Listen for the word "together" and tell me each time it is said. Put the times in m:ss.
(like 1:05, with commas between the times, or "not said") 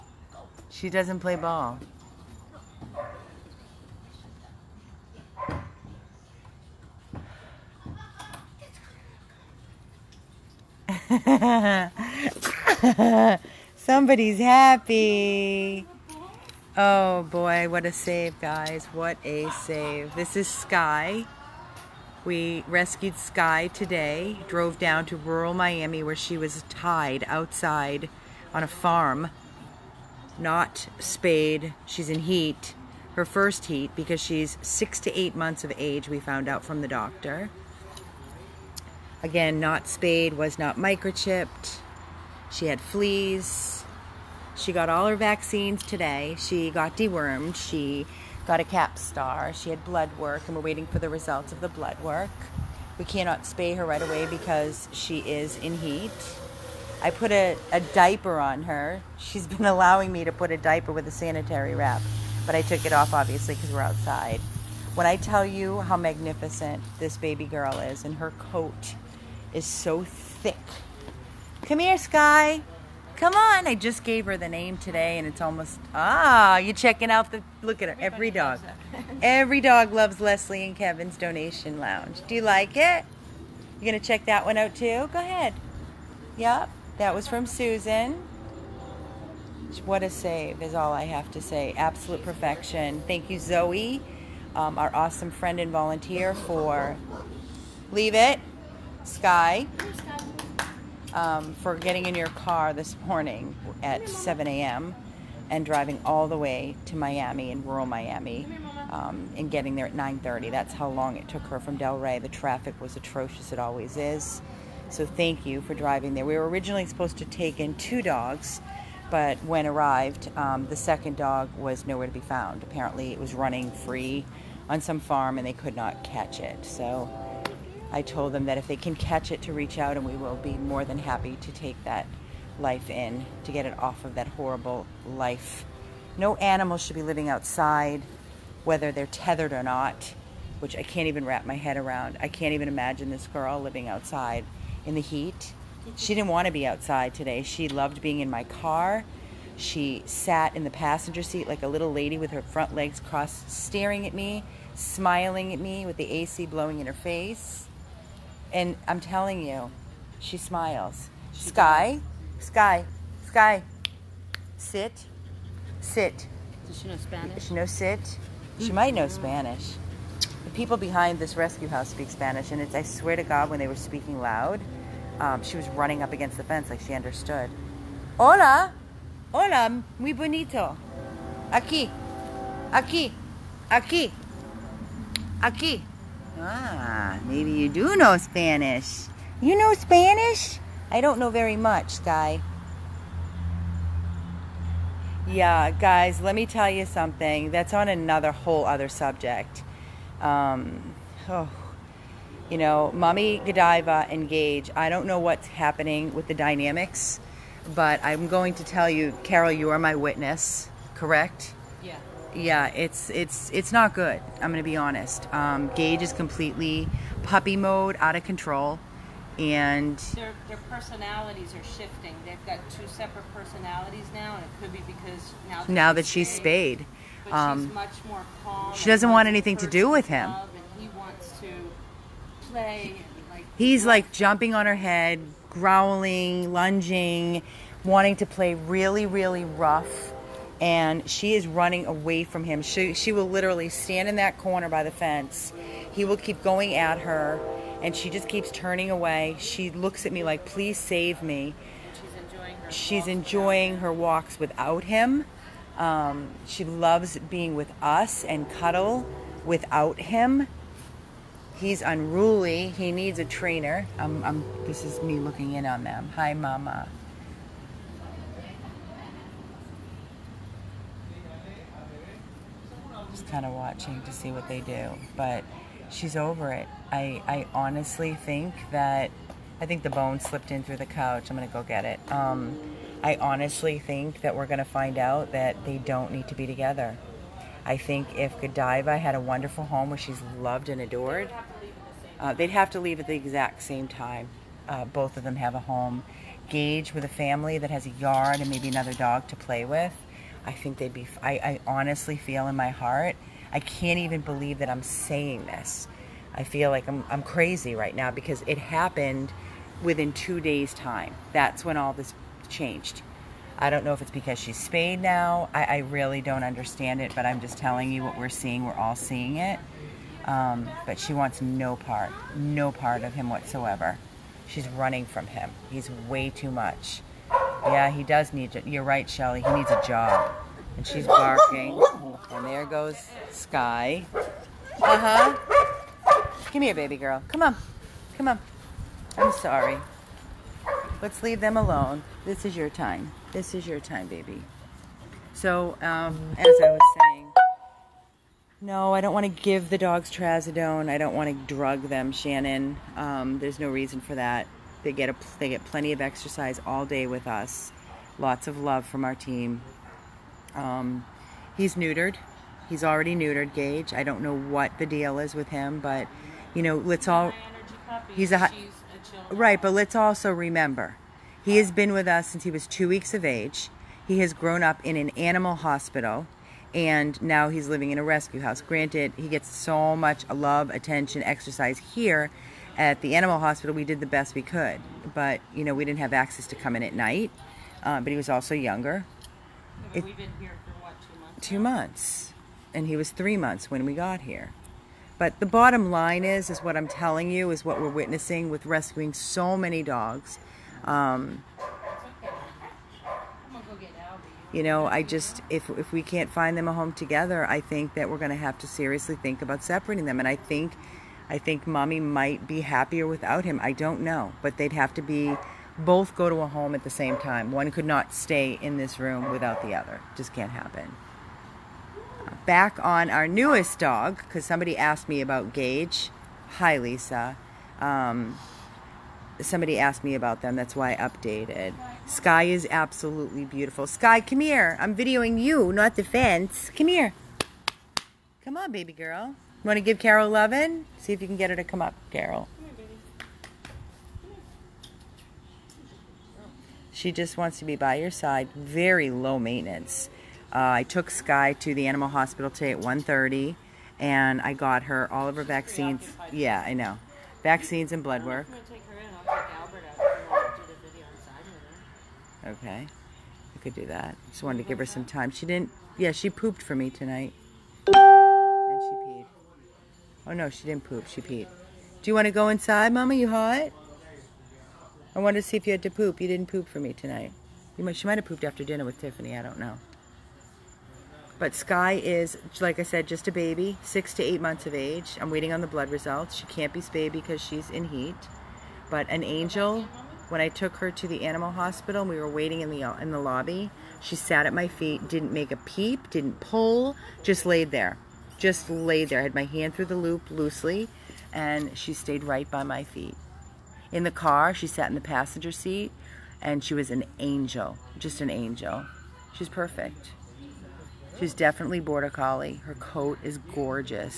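4:46, 6:46.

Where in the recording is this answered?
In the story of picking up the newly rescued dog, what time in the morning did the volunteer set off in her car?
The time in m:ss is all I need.
1:44.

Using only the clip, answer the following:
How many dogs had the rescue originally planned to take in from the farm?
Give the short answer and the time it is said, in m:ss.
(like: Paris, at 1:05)
2, at 1:57.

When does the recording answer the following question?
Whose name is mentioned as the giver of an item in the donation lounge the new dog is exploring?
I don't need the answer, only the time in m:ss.
1:27.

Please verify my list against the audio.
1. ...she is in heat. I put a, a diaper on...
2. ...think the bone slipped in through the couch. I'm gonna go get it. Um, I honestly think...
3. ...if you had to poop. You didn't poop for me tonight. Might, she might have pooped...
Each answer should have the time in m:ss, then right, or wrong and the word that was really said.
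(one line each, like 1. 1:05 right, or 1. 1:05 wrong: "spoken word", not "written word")
1. 0:54 right
2. 4:39 right
3. 7:55 right.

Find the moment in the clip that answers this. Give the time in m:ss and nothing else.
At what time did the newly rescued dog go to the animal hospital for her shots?
7:32.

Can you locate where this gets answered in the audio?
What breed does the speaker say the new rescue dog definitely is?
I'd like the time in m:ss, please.
8:31.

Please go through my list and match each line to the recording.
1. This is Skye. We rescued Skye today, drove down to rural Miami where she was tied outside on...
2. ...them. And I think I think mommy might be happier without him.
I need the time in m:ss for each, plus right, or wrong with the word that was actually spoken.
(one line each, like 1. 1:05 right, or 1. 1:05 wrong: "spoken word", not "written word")
1. 0:20 right
2. 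6:50 right.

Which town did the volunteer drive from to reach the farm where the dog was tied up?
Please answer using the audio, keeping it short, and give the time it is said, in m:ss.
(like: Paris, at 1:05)
Delray, at 1:51.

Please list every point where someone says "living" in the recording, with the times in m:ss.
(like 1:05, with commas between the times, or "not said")
2:17, 2:23, 6:17.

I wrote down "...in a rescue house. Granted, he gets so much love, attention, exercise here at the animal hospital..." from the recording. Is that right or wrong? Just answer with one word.
right.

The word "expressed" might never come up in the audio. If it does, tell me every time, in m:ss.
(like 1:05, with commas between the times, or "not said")
not said.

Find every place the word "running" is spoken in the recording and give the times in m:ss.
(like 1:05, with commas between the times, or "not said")
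2:03, 2:55, 4:01, 5:24.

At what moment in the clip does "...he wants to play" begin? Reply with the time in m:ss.
3:50.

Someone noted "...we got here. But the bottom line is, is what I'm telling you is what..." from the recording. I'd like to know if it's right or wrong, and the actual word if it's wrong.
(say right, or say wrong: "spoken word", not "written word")
right.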